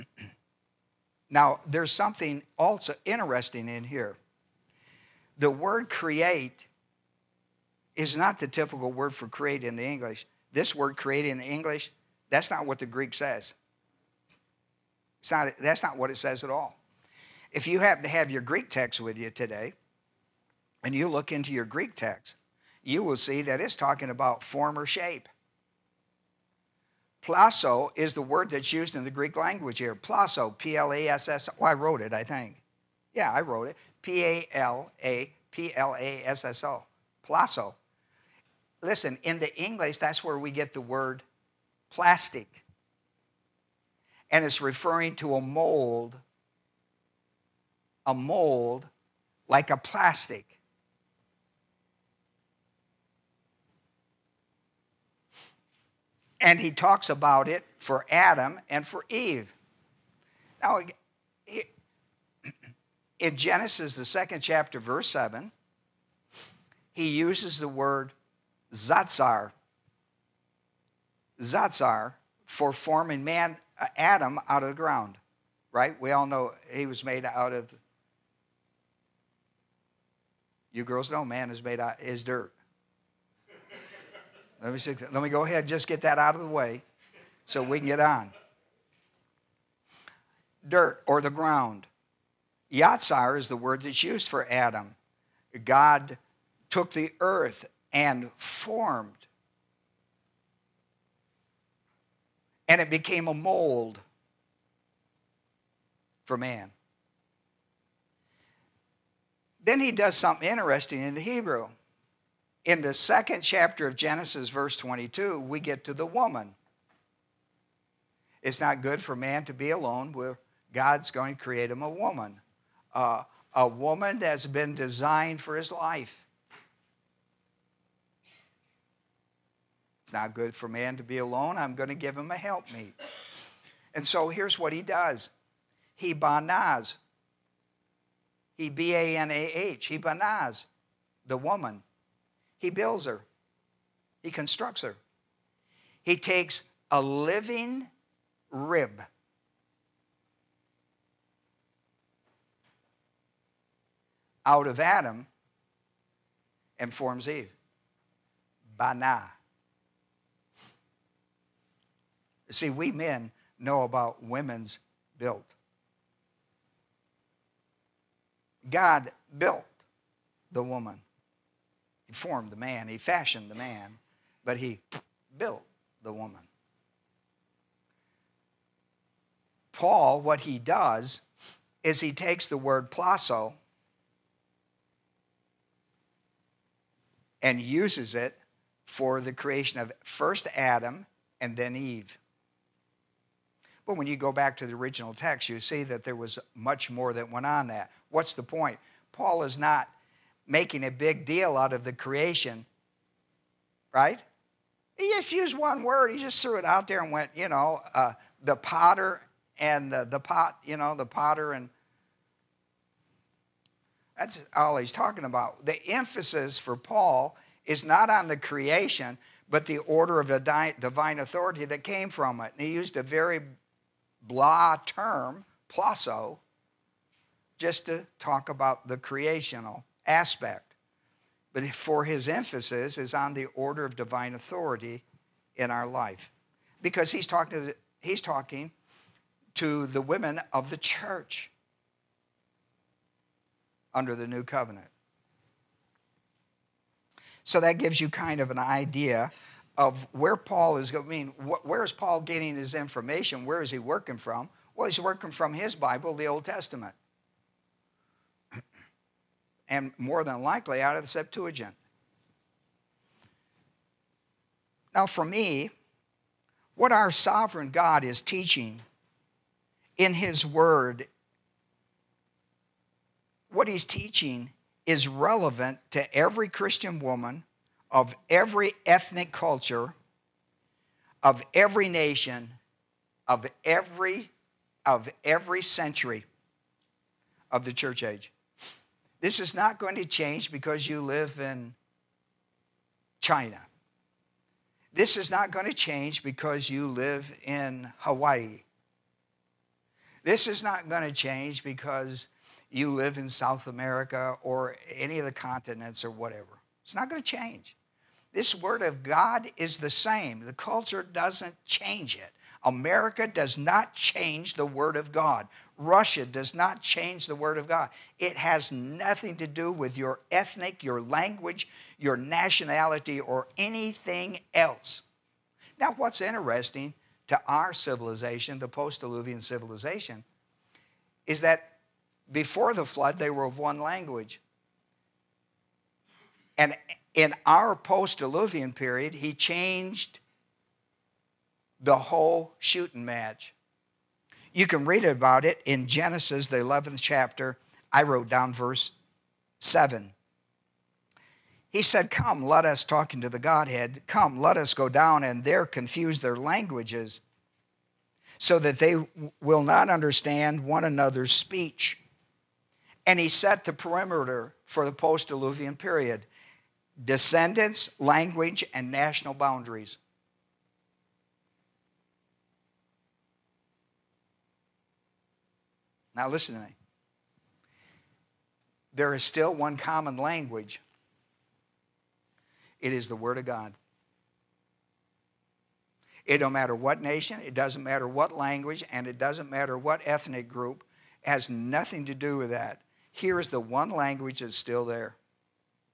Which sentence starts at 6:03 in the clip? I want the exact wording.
And he set the perimeter for the post diluvian period descendants, language, and national boundaries.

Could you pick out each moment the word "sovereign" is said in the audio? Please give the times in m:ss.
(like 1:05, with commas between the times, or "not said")
4:27.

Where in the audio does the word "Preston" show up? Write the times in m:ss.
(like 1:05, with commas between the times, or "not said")
not said.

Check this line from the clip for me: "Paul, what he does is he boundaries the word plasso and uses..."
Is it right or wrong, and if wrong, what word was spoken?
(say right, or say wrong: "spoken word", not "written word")
wrong: "takes", not "boundaries".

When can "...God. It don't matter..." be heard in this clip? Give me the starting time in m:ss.
6:23.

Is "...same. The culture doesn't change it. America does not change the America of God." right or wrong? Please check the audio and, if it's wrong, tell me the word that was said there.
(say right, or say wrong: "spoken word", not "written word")
wrong: "Word", not "America".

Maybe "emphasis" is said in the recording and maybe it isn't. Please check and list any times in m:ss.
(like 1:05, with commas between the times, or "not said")
3:35, 3:52.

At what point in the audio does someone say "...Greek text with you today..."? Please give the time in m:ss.
0:18.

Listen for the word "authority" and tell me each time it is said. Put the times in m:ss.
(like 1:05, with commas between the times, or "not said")
3:41, 3:54.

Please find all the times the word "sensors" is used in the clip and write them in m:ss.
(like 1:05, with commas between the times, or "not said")
not said.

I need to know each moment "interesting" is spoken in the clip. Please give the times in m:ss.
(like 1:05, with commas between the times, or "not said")
0:03, 1:50, 5:26.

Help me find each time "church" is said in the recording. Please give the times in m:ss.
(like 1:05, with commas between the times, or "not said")
4:00, 4:47.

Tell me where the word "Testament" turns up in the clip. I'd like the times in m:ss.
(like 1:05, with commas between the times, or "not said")
4:16.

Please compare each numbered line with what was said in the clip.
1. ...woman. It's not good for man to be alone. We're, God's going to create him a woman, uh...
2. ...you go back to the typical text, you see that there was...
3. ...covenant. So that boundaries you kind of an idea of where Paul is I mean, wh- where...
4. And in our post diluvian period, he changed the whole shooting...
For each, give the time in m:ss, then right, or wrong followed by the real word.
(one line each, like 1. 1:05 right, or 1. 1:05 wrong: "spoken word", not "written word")
1. 1:56 right
2. 3:14 wrong: "original", not "typical"
3. 4:04 wrong: "gives", not "boundaries"
4. 5:36 right.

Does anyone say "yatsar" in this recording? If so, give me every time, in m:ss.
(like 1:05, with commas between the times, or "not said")
1:11, 1:32.